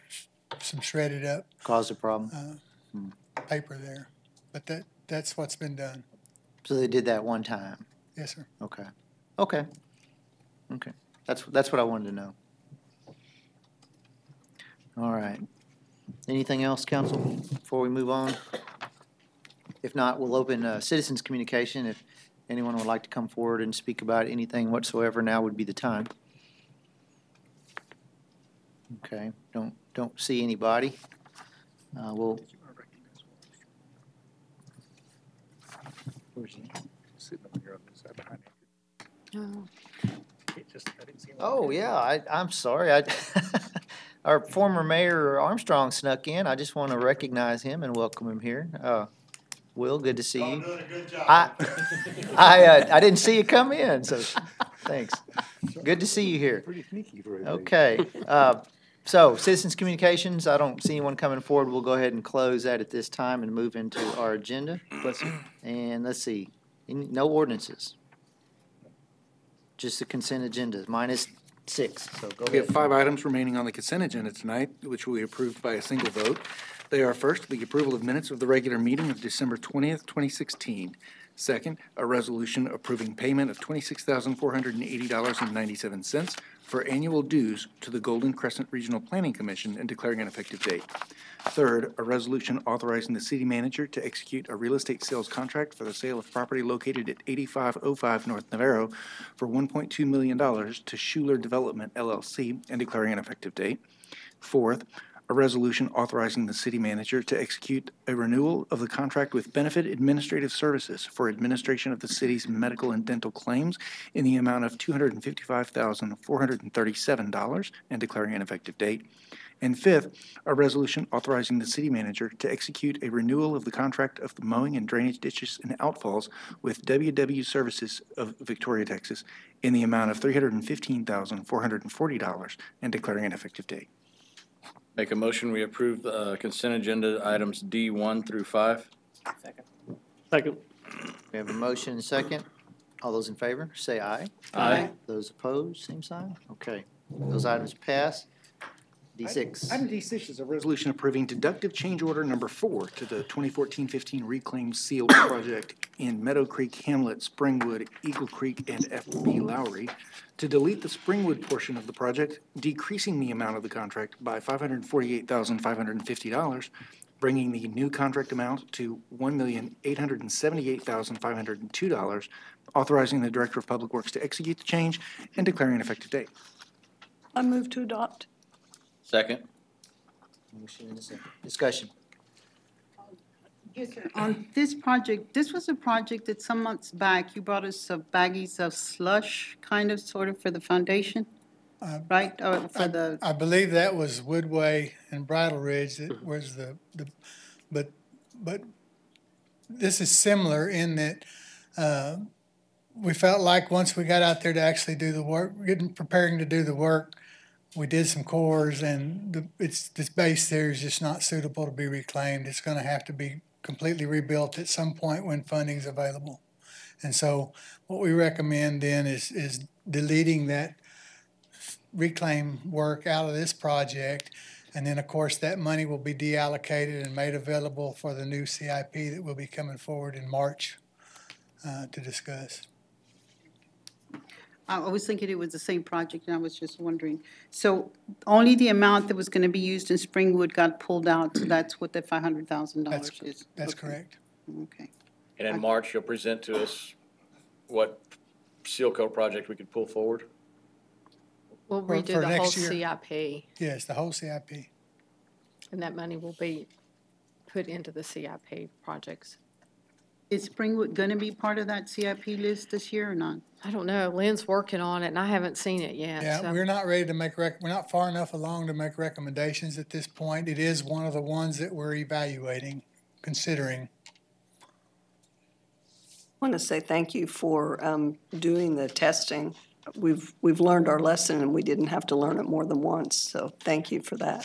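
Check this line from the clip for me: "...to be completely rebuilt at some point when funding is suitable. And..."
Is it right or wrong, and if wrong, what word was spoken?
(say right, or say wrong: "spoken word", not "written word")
wrong: "available", not "suitable".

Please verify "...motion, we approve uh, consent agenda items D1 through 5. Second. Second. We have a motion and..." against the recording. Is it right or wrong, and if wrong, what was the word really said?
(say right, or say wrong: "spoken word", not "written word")
right.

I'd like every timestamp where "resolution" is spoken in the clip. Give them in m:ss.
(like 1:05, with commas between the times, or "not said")
1:22, 1:32, 1:45, 2:00, 2:30.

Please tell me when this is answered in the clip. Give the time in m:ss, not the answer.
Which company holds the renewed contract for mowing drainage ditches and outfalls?
2:06.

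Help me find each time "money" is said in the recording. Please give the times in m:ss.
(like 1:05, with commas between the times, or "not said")
3:45, 4:15.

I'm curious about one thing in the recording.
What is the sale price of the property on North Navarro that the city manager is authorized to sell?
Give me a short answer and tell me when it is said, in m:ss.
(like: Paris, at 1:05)
$1.2 million, at 1:39.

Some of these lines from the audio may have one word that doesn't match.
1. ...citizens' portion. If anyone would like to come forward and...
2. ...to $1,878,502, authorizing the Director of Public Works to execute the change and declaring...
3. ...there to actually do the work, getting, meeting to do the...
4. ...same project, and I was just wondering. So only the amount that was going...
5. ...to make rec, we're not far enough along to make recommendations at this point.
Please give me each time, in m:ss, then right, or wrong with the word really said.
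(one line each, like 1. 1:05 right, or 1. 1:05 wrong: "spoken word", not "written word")
1. 0:20 wrong: "communication", not "portion"
2. 2:48 right
3. 3:24 wrong: "preparing", not "meeting"
4. 3:55 right
5. 4:27 right.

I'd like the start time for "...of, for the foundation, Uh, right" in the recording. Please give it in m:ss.
3:10.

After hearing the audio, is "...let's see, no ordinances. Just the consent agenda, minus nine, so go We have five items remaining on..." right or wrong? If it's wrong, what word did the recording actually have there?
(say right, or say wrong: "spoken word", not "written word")
wrong: "six", not "nine".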